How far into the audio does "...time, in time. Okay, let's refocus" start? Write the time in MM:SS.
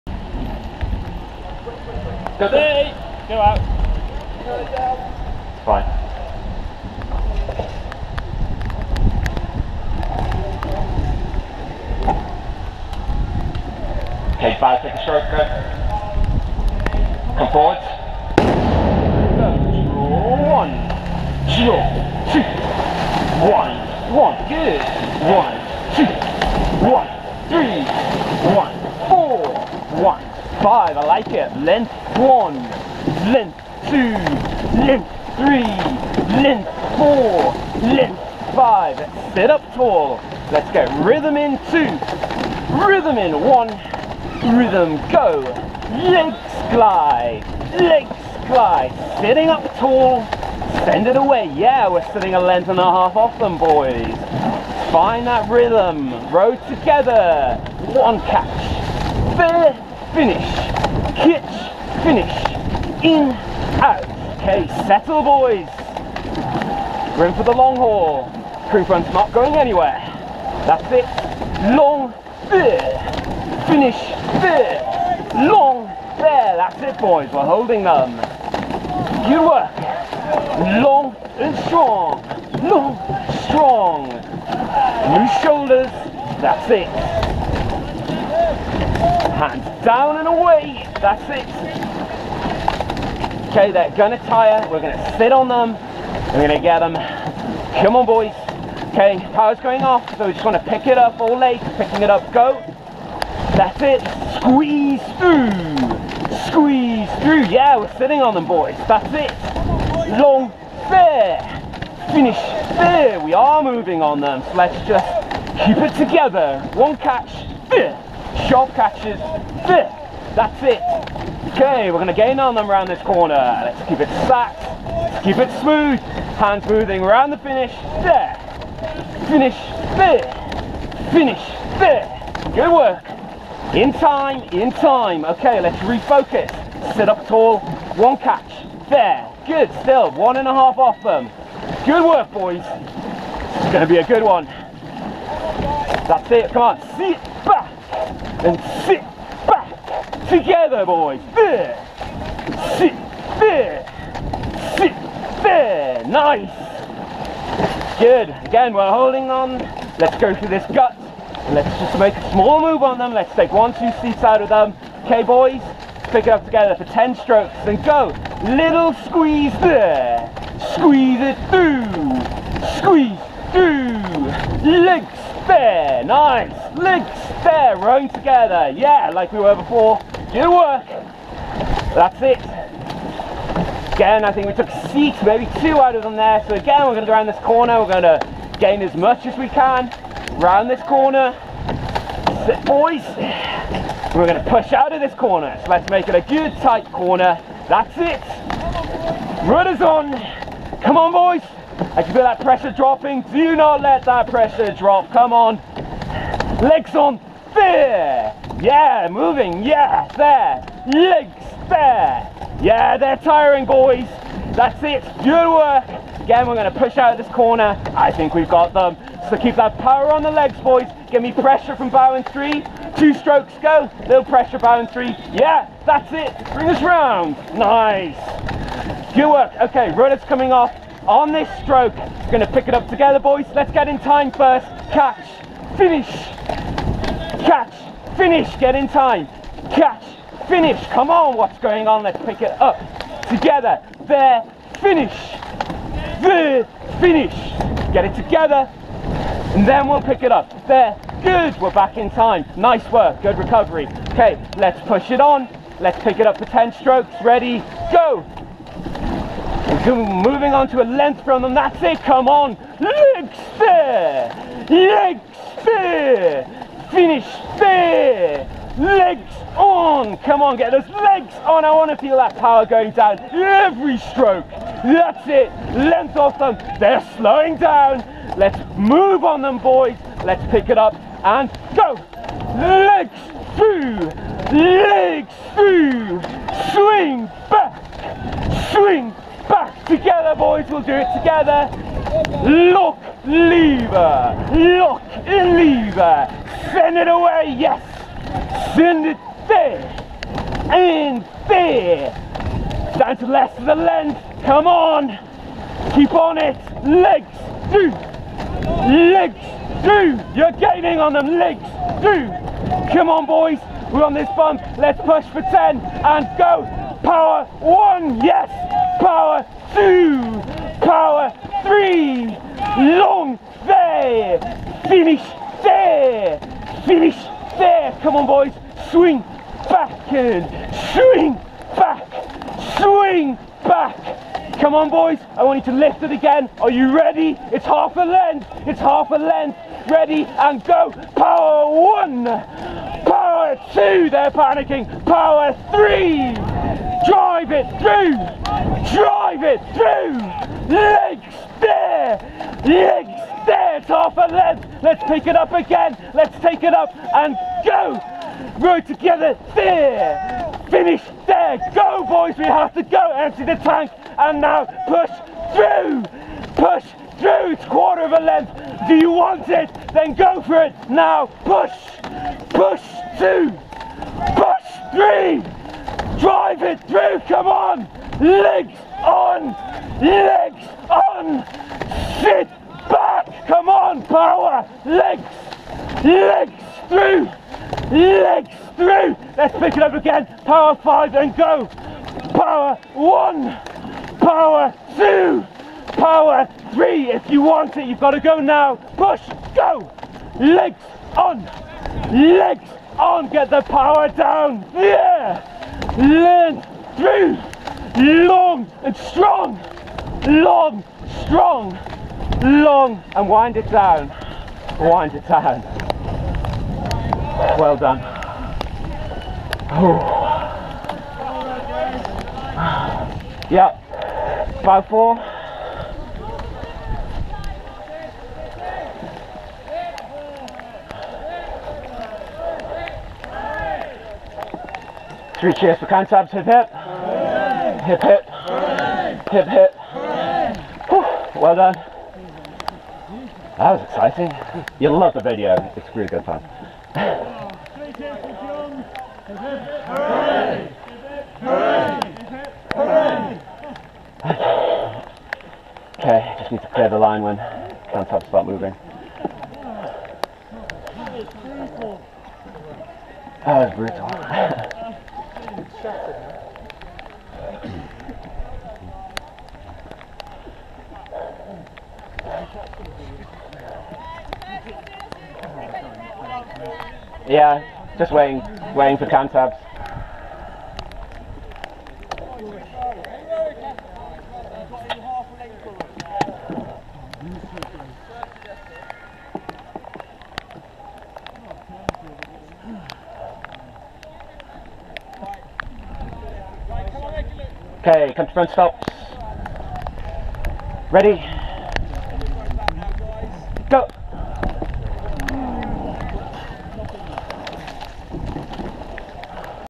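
02:13.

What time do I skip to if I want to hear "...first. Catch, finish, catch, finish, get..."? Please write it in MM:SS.
03:54.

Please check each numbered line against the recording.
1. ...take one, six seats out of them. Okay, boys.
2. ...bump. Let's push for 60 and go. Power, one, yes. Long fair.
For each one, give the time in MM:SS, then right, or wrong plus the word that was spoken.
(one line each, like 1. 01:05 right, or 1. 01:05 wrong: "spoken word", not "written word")
1. 02:43 wrong: "two", not "six"
2. 05:14 wrong: "10", not "60".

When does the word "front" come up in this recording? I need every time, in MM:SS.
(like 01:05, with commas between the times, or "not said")
01:08, 08:18.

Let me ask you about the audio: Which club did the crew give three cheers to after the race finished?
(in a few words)
Cantabs.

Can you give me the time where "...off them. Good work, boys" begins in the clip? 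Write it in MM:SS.
02:20.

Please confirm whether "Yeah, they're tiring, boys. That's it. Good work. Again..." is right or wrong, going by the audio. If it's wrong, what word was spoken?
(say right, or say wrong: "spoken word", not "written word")
right.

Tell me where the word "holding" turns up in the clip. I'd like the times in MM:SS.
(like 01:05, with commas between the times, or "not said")
01:17, 02:38.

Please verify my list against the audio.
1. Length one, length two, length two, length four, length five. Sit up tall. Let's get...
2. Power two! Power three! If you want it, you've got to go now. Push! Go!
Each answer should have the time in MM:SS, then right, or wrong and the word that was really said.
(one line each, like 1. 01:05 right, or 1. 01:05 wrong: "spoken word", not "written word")
1. 00:31 wrong: "three", not "two"
2. 06:34 right.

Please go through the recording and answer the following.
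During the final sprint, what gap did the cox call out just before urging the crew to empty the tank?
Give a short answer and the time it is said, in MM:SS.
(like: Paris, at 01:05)
Quarter of a length, at 06:07.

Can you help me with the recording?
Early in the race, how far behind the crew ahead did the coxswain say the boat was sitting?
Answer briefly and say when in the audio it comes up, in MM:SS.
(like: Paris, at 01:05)
A length and a half, at 00:52.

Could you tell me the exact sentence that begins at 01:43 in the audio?
That's it, squeeze through, squeeze through.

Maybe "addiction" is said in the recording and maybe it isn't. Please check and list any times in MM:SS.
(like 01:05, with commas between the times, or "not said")
not said.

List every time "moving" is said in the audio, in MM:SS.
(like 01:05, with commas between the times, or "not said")
01:53, 02:06, 03:29, 04:19, 07:38.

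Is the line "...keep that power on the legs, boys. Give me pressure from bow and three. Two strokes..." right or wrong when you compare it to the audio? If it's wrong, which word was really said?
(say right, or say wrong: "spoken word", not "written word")
right.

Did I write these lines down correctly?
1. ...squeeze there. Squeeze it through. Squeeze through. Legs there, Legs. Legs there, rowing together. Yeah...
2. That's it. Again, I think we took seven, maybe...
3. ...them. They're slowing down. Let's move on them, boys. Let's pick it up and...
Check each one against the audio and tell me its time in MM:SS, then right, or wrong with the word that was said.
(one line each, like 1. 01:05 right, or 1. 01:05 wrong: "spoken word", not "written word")
1. 02:49 wrong: "Nice", not "Legs"
2. 03:01 wrong: "six", not "seven"
3. 04:36 right.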